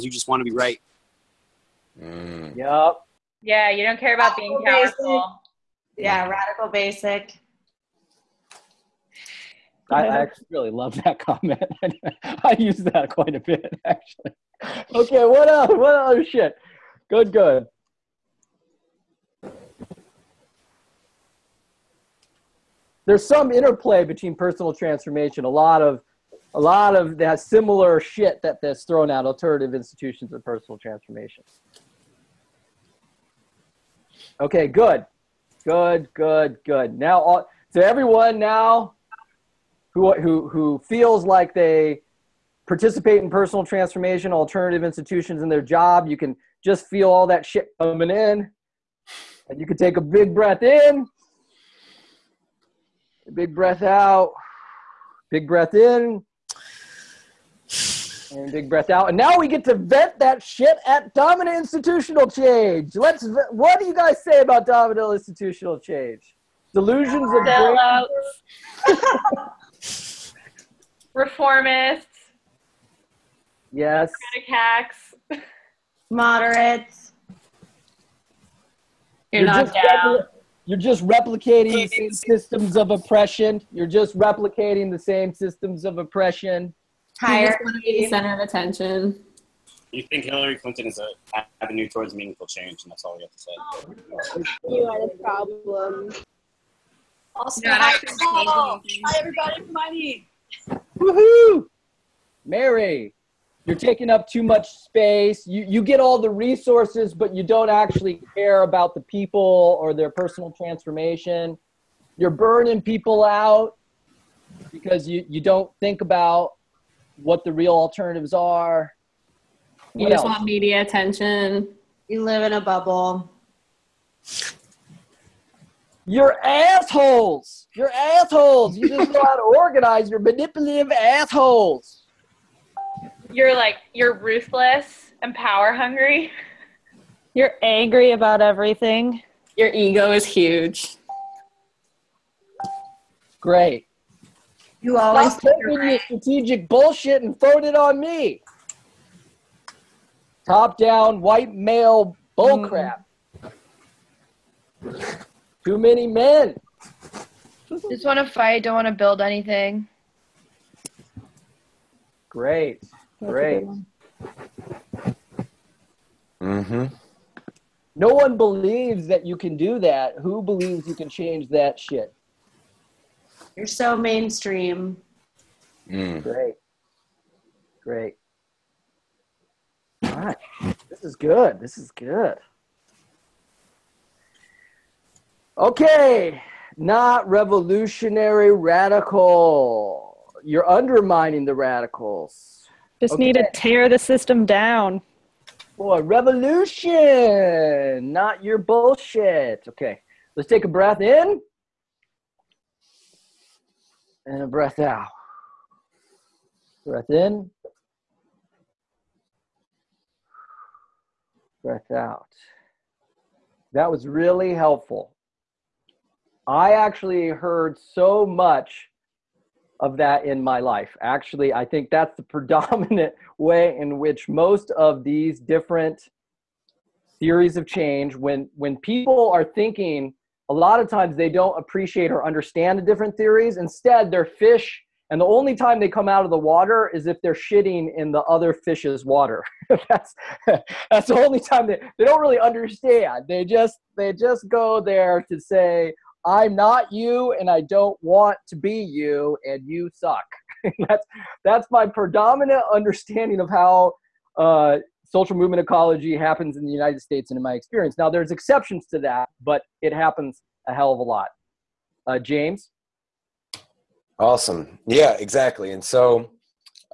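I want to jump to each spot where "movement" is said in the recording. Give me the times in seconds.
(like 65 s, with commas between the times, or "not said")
255 s.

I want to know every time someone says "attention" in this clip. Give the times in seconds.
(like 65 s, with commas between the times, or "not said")
88 s, 120 s.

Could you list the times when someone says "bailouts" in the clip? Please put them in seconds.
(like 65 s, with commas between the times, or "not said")
67 s.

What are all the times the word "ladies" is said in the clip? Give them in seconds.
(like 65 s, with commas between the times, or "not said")
not said.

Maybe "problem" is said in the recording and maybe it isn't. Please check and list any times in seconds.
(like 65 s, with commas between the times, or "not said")
95 s.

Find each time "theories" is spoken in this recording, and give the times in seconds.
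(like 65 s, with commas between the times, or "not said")
227 s, 233 s.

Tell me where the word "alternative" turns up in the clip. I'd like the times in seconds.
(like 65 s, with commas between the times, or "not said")
29 s, 44 s, 117 s.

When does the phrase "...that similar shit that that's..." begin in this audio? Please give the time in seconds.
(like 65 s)
27 s.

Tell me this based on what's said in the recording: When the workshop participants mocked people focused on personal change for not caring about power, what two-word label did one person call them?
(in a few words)
Radical basic.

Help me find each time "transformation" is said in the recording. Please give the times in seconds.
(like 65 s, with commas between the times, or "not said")
24 s, 30 s, 43 s, 110 s.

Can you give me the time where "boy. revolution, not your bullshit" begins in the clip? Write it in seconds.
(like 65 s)
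195 s.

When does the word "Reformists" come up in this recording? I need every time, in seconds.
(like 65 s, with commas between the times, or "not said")
71 s.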